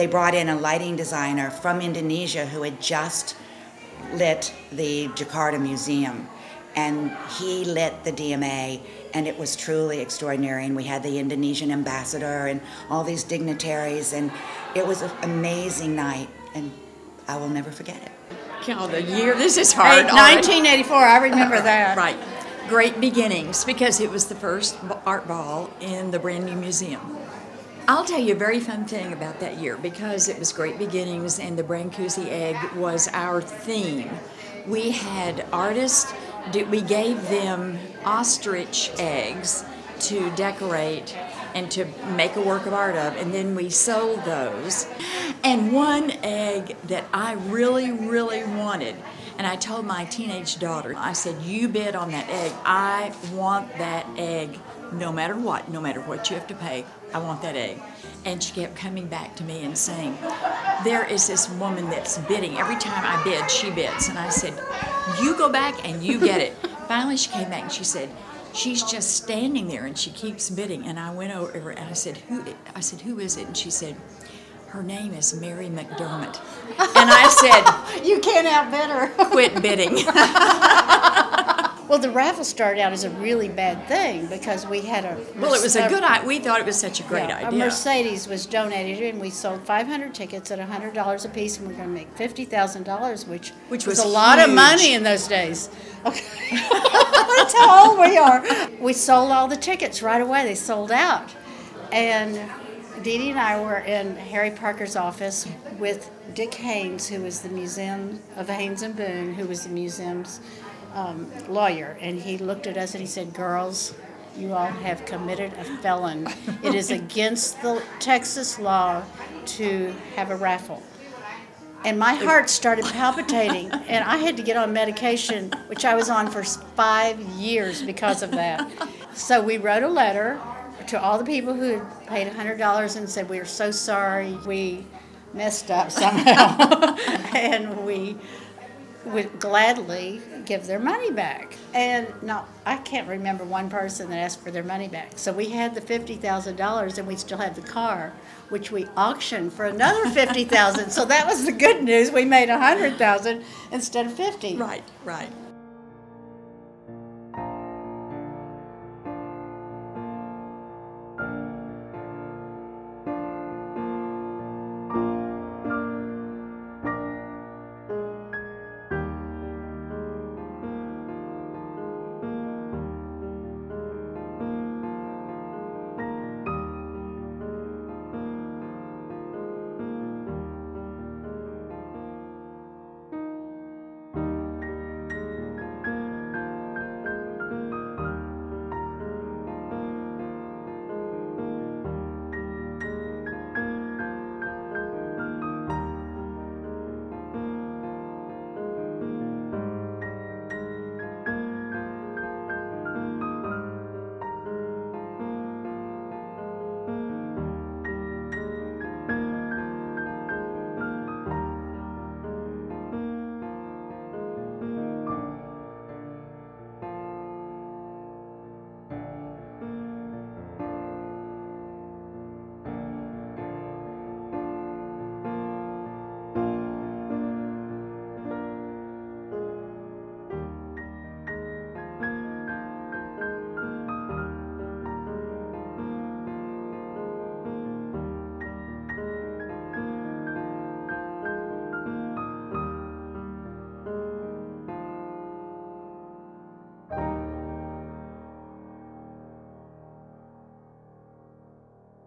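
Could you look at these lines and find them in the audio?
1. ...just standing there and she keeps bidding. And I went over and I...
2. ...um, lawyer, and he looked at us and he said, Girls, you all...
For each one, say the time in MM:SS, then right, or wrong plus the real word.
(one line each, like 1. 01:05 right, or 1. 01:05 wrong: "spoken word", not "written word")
1. 01:08 right
2. 01:50 right.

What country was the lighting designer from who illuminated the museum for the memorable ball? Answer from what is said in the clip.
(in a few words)
Indonesia.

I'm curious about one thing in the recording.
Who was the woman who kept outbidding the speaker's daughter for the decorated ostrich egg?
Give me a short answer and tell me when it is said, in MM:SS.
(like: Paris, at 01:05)
Mary McDermott, at 01:15.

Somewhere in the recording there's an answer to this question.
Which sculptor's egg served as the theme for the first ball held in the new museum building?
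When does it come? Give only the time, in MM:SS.
00:31.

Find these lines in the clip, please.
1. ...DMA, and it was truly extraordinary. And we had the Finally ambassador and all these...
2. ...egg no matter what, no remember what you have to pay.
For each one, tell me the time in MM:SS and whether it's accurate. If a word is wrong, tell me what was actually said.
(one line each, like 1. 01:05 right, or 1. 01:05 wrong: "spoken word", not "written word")
1. 00:08 wrong: "Indonesian", not "Finally"
2. 00:54 wrong: "matter", not "remember".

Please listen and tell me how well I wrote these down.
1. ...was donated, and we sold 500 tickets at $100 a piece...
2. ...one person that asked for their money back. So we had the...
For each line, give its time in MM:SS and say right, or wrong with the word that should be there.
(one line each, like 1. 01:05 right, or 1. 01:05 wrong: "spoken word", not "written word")
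1. 01:28 right
2. 02:23 right.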